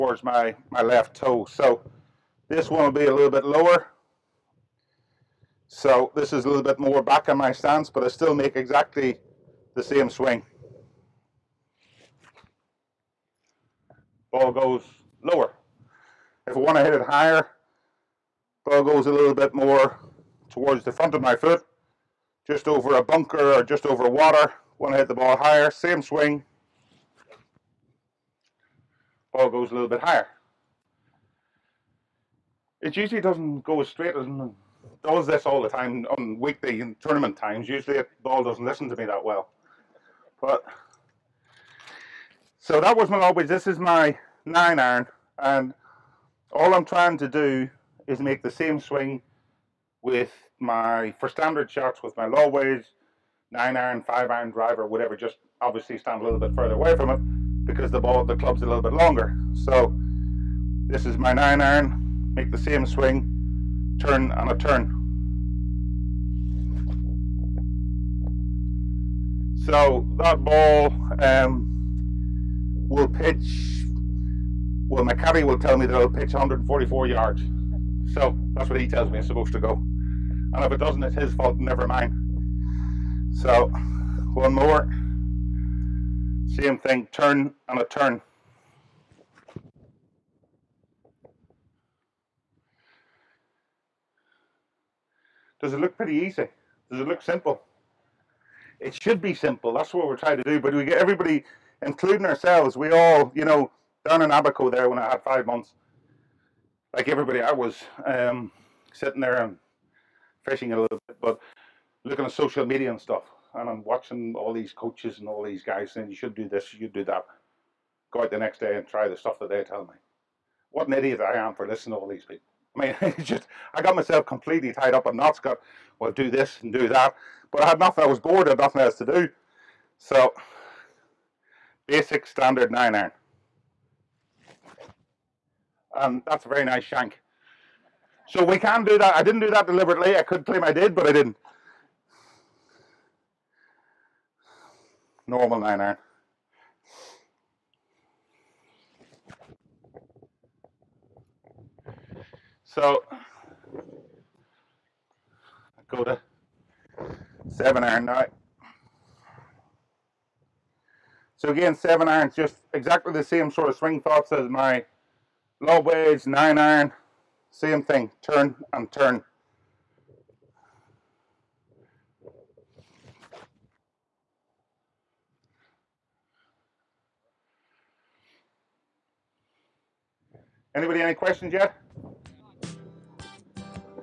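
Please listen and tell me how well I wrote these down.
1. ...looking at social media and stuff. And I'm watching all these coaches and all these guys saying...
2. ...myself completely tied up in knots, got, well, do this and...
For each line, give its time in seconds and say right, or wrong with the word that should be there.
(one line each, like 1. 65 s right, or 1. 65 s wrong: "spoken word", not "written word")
1. 112 s right
2. 123 s right.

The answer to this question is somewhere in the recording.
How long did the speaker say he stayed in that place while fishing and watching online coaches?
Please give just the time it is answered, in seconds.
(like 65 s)
105 s.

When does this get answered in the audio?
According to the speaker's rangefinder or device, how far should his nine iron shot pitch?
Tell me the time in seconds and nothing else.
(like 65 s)
76 s.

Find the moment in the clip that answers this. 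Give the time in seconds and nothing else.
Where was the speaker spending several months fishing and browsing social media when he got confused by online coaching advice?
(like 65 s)
104 s.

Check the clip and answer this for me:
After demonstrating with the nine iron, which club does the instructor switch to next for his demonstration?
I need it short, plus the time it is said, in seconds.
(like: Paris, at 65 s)
7 iron, at 157 s.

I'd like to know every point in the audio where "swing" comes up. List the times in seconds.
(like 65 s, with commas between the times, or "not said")
10 s, 26 s, 48 s, 62 s, 163 s.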